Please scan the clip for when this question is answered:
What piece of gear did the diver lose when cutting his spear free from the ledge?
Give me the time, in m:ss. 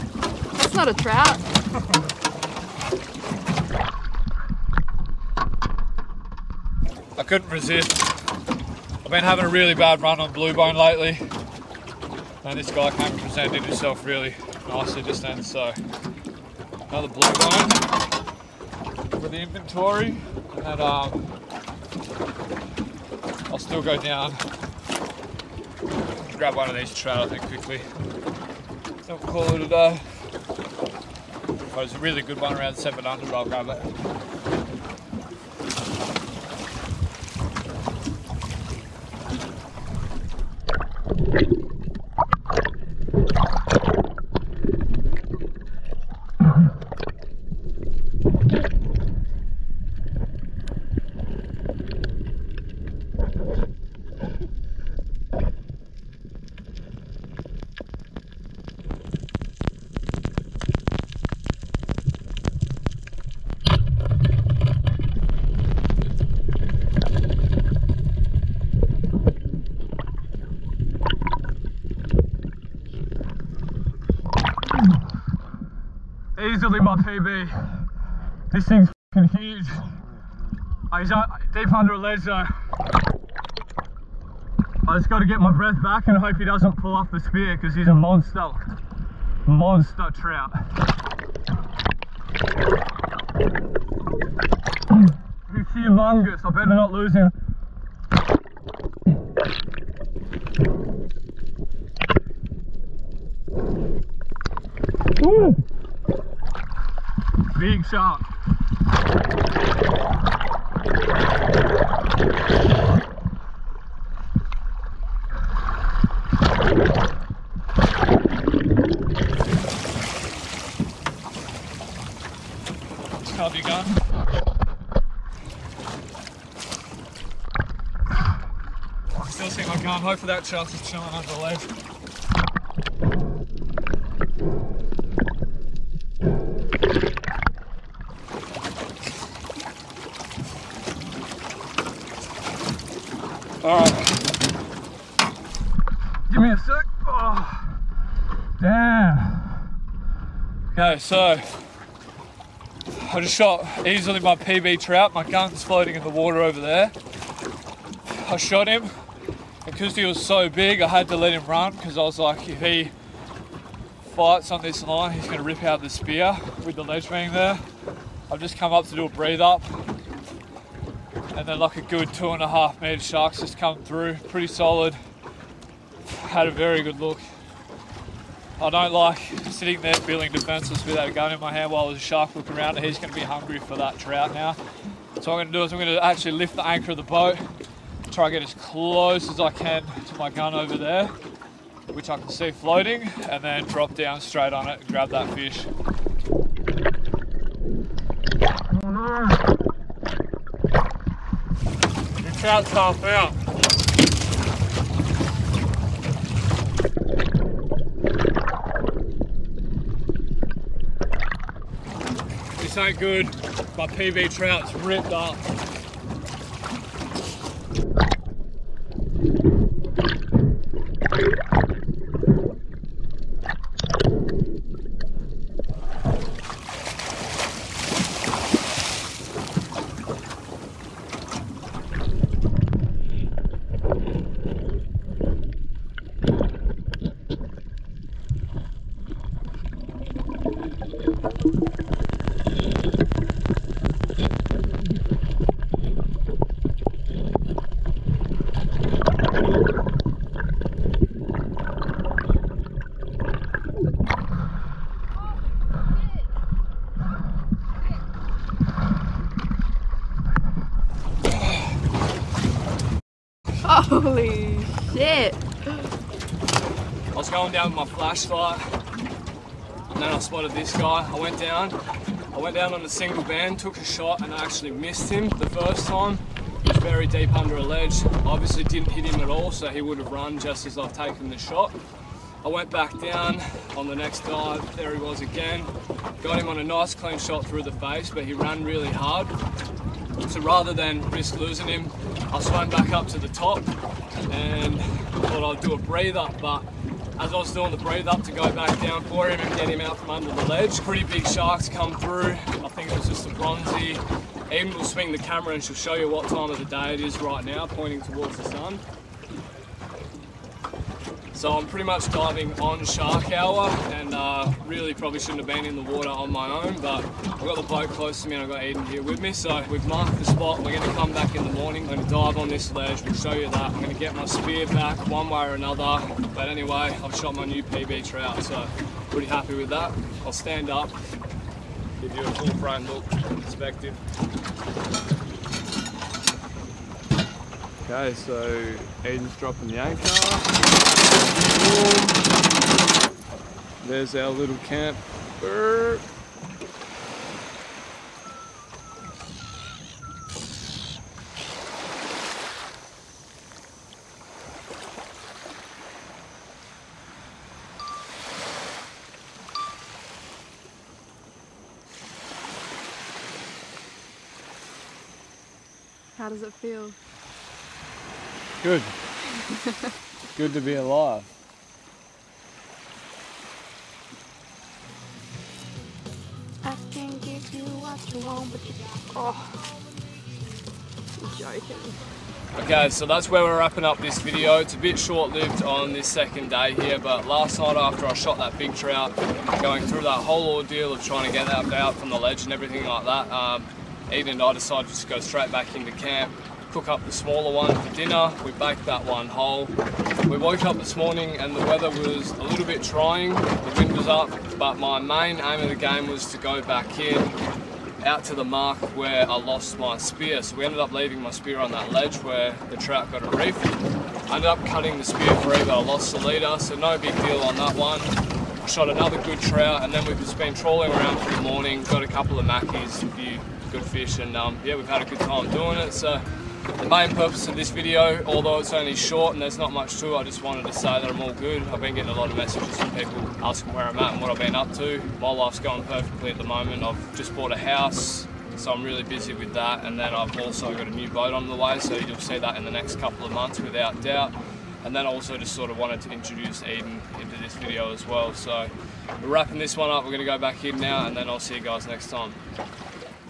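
6:56.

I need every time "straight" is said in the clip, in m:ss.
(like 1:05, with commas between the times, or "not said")
3:14, 6:35.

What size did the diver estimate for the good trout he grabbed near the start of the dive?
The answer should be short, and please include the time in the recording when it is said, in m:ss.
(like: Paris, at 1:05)
700, at 0:32.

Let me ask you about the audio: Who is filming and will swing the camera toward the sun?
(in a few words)
Amy.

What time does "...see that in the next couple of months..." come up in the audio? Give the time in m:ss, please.
7:22.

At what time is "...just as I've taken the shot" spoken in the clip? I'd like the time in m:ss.
4:40.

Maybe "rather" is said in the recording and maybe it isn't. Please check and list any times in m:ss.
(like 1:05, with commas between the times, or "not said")
4:50.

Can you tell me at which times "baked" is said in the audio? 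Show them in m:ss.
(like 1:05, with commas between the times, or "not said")
6:38.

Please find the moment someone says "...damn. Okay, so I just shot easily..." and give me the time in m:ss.
2:28.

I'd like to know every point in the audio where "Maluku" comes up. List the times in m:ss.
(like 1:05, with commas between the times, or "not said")
not said.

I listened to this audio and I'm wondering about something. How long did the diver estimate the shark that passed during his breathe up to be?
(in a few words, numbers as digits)
2.5 meters.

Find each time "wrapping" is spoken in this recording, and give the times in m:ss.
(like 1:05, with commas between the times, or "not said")
6:23, 7:29.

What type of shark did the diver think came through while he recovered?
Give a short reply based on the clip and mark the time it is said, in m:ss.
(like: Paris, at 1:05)
Bronzy, at 5:03.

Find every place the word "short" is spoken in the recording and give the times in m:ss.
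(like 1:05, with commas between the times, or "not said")
6:24, 7:08.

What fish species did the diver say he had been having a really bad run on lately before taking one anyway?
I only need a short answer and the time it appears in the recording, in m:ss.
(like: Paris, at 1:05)
Blue bone, at 0:10.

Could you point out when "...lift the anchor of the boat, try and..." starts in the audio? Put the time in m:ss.
3:06.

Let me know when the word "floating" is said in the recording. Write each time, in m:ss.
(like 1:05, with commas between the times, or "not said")
2:35, 3:12.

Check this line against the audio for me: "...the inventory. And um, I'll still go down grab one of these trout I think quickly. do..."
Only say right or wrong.
right.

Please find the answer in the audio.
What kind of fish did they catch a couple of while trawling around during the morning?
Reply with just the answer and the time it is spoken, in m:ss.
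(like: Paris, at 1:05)
Mackies, at 7:02.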